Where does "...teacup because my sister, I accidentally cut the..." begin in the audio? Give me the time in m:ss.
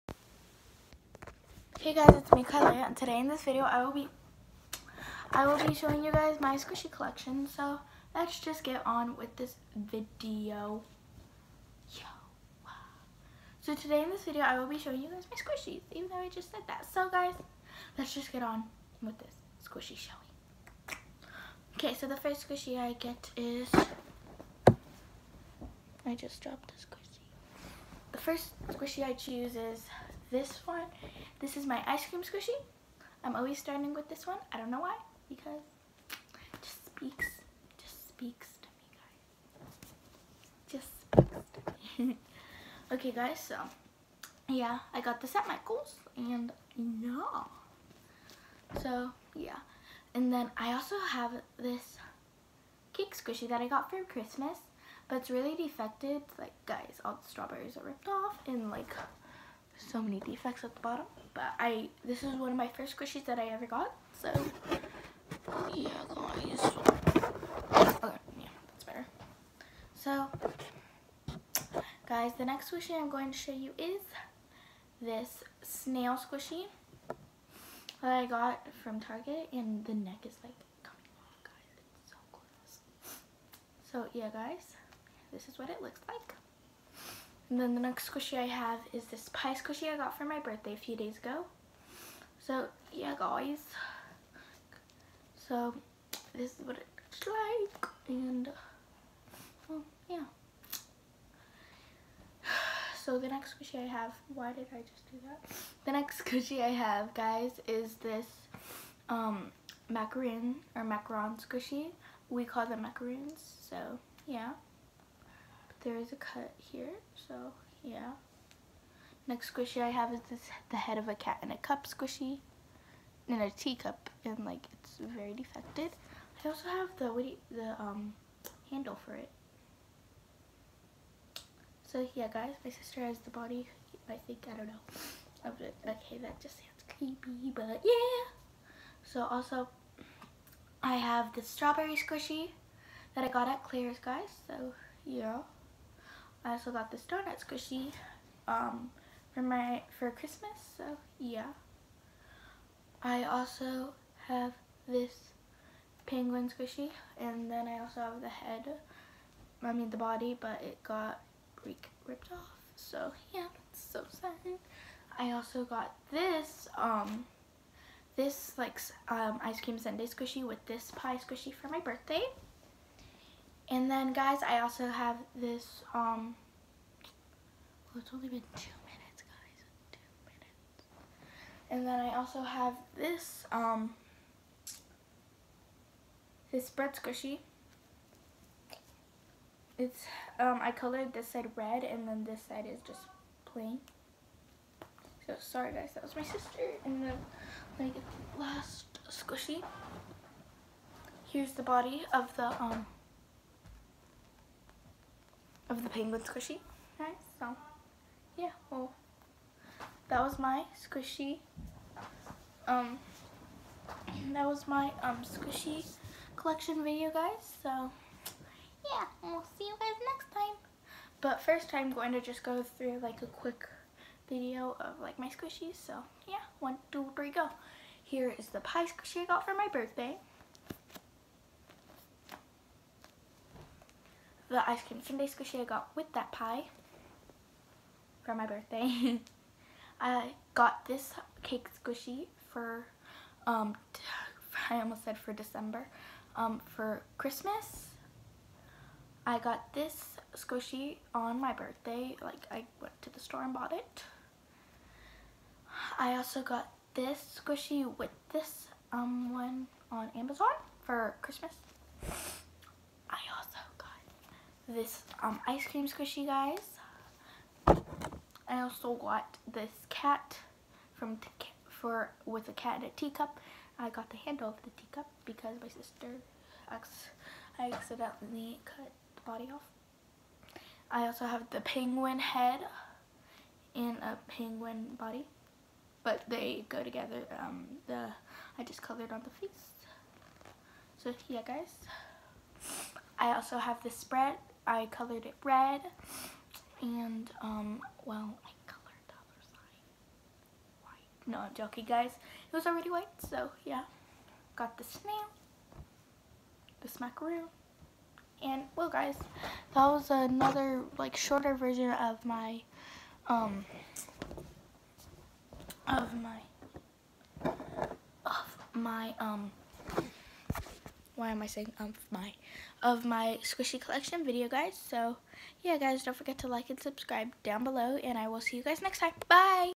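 4:34.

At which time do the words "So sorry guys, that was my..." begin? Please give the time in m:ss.
3:15.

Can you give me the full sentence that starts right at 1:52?
We call them macaroons so yeah there is a cut here, so yeah.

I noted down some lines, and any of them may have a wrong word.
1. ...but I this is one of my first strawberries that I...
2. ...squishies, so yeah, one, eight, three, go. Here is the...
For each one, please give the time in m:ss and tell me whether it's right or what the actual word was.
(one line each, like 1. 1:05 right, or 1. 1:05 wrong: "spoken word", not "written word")
1. 1:01 wrong: "squishies", not "strawberries"
2. 3:45 wrong: "two", not "eight".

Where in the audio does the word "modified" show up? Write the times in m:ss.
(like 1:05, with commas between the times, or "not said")
not said.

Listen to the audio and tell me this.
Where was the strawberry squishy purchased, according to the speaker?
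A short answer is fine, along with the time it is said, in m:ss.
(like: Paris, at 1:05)
Claire's, at 2:23.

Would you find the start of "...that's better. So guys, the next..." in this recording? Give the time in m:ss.
1:08.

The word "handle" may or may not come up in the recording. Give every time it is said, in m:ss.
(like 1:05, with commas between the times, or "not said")
2:08, 4:34.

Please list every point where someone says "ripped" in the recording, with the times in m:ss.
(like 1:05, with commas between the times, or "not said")
0:57, 2:41.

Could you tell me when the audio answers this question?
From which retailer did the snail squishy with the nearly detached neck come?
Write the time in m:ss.
1:18.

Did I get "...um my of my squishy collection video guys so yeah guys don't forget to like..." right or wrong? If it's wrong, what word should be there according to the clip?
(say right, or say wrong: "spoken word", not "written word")
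right.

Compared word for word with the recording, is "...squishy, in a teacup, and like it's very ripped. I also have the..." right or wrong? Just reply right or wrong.
wrong.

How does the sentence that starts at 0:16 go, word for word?
So guys, let's just get on with this squishy showing.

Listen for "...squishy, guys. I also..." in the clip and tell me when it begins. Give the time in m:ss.
4:25.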